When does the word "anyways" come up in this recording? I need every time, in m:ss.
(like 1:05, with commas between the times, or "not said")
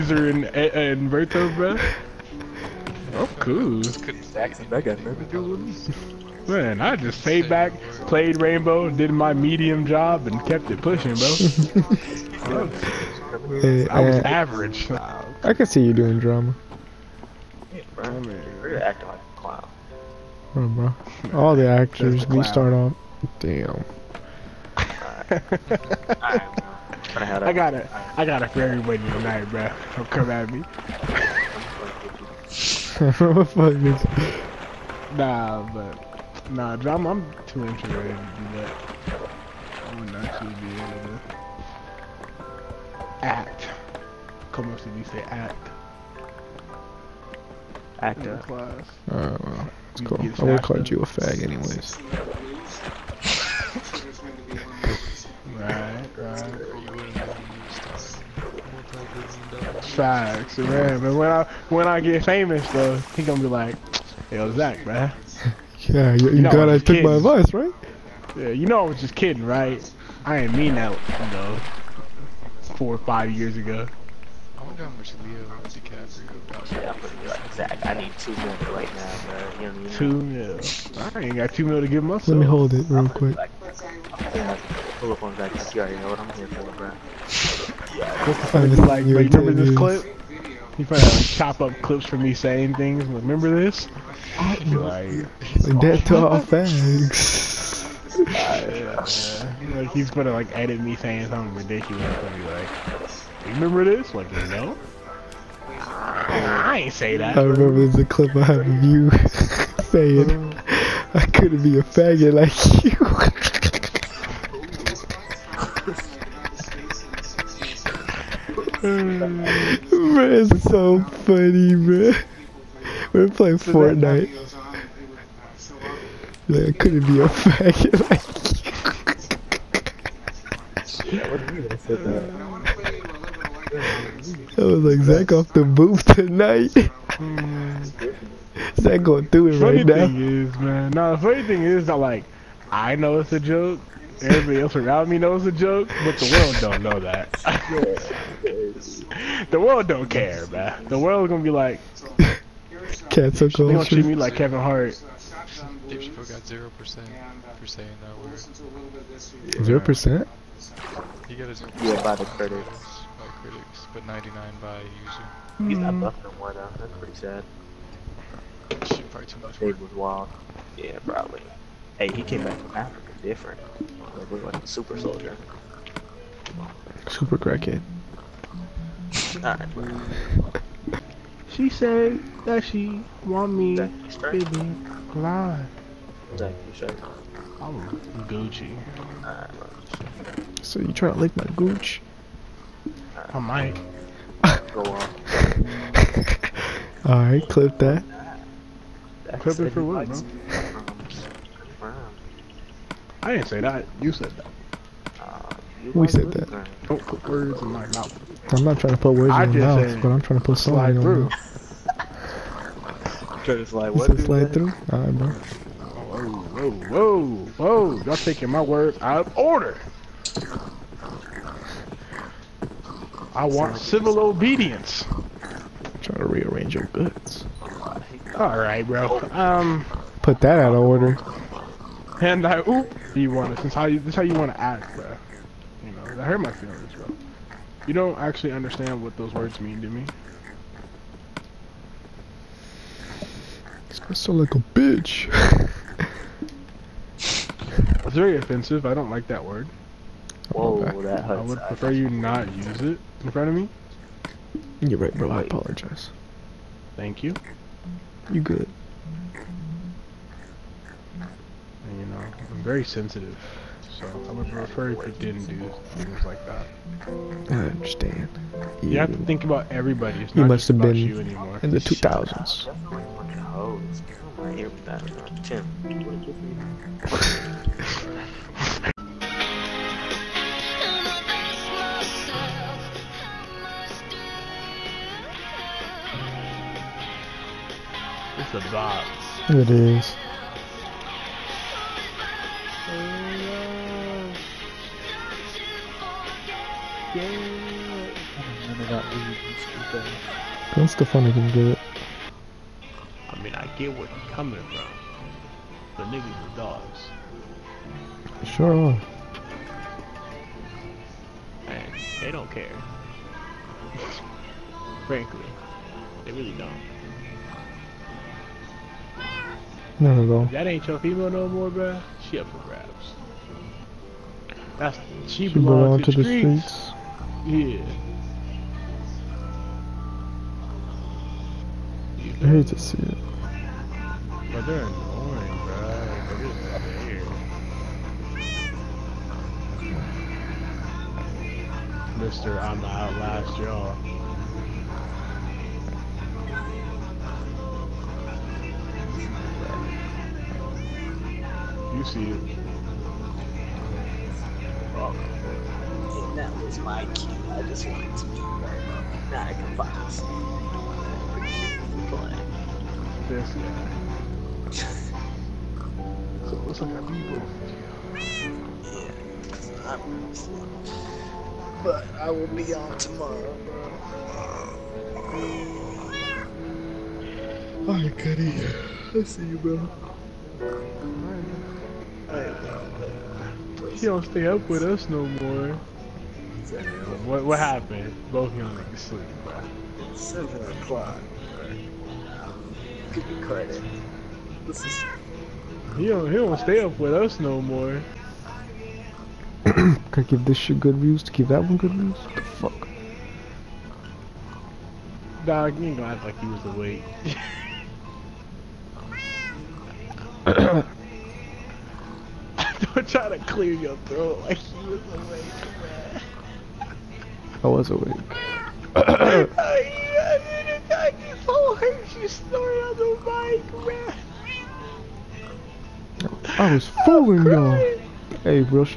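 0:51.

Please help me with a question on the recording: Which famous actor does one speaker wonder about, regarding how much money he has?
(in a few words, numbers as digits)
Leo DiCaprio.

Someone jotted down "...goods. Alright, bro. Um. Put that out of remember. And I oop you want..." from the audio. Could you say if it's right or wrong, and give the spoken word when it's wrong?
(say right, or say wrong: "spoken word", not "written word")
wrong: "order", not "remember".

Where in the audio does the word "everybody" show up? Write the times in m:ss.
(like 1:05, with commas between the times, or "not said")
2:24, 4:29.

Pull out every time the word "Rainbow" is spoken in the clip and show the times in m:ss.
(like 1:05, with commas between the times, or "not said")
0:08.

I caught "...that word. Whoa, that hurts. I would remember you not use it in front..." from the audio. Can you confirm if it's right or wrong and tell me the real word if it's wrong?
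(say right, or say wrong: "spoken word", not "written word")
wrong: "prefer", not "remember".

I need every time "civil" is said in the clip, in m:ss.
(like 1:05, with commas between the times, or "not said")
3:43.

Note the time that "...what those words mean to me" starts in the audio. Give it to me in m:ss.
3:59.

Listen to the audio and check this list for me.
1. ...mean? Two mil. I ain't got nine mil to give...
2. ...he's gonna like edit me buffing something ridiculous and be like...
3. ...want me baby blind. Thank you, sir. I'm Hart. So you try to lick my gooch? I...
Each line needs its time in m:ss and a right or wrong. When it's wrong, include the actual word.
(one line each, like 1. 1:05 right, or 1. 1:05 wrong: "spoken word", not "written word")
1. 1:19 wrong: "two", not "nine"
2. 1:39 wrong: "saying", not "buffing"
3. 3:03 wrong: "Gucci", not "Hart".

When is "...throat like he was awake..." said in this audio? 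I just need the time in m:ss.
6:54.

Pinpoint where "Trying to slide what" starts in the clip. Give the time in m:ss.
3:33.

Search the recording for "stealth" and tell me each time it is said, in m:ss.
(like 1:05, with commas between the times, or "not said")
not said.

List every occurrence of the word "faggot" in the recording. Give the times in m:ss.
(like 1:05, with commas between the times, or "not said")
1:51, 2:07.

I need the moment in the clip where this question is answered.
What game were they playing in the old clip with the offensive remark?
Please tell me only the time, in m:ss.
2:03.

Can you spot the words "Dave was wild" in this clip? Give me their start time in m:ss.
2:49.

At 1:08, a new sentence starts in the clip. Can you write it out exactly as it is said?
Yeah, you know I was just kidding, right?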